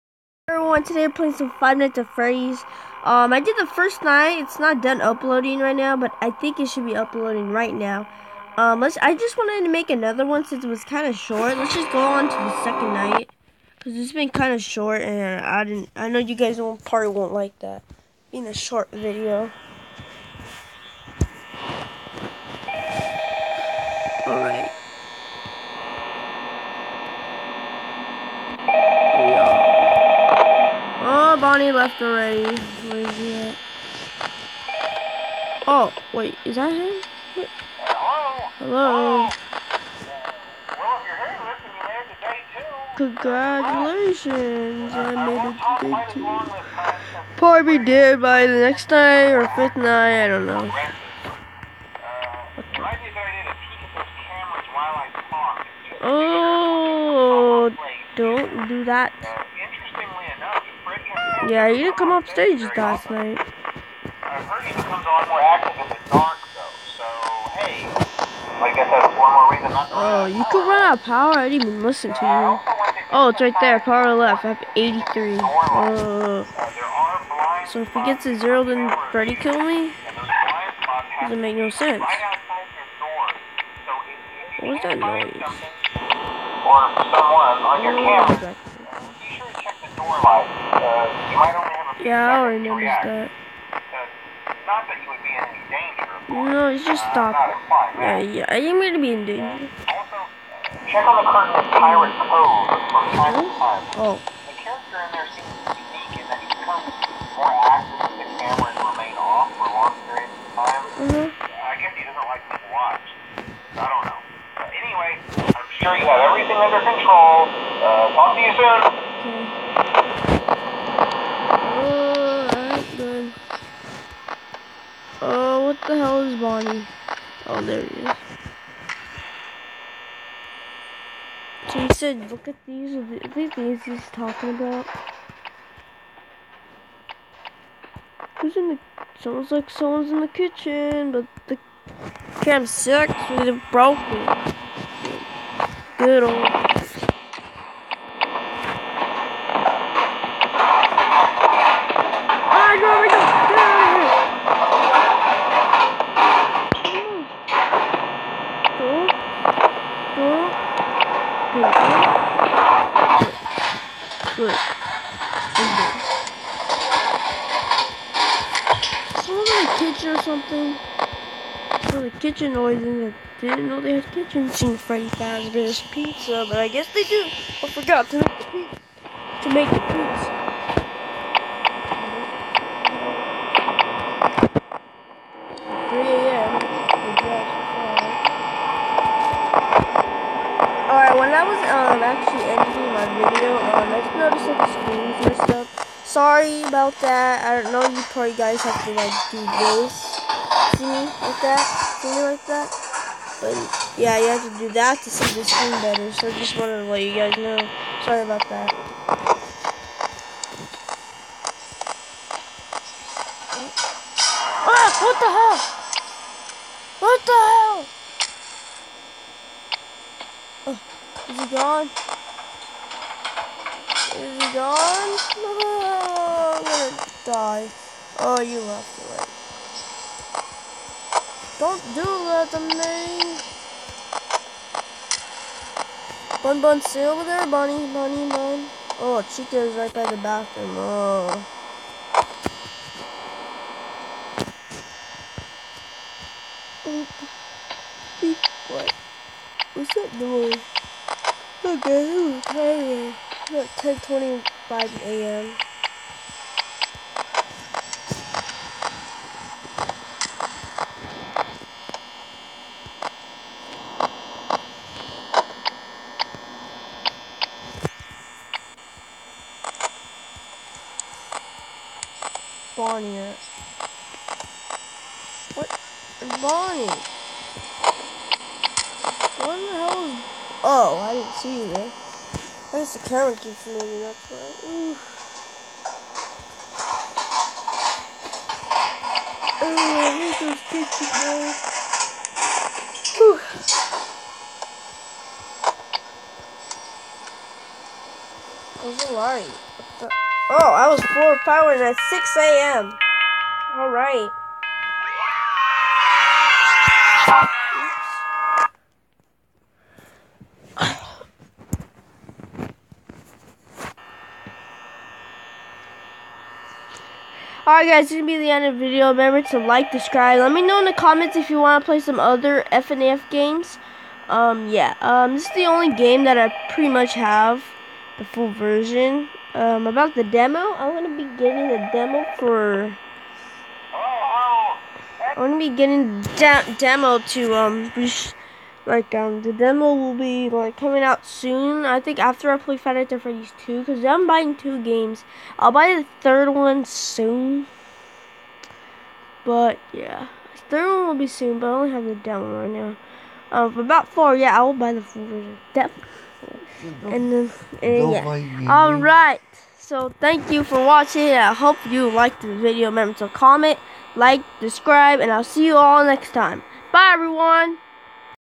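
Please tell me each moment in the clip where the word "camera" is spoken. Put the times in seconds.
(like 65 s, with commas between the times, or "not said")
88 s, 282 s.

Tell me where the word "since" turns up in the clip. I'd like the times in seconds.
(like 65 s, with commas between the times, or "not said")
10 s.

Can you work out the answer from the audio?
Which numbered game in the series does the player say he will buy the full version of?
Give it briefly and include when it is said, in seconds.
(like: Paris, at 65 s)
Four, at 354 s.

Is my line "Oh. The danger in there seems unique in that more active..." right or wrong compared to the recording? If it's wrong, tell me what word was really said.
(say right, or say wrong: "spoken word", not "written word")
wrong: "character", not "danger".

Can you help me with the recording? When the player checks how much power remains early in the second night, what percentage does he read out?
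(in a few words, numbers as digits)
83.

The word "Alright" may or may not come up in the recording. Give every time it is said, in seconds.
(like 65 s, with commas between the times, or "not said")
303 s, 317 s.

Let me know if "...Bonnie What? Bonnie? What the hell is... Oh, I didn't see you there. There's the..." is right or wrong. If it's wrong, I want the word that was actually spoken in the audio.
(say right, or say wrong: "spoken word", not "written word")
right.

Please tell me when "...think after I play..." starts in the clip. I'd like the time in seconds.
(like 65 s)
342 s.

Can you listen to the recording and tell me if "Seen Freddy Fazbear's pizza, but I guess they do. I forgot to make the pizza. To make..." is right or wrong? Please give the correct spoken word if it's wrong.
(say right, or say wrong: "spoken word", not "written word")
right.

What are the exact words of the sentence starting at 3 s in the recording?
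Um, I did the first night, it's not done uploading right now, but I think it should be uploading right now.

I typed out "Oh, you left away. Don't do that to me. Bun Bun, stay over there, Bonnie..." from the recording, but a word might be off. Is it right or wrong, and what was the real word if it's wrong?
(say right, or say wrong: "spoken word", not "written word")
wrong: "Bunny", not "Bonnie".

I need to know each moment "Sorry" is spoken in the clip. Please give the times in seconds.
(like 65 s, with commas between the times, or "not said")
196 s, 208 s.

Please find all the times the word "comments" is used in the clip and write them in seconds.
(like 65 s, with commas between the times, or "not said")
320 s, 363 s.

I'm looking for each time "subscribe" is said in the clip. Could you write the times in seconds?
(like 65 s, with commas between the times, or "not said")
319 s, 364 s.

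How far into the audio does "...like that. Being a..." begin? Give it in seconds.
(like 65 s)
17 s.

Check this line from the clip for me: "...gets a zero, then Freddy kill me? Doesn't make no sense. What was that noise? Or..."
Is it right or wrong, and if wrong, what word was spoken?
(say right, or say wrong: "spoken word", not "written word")
right.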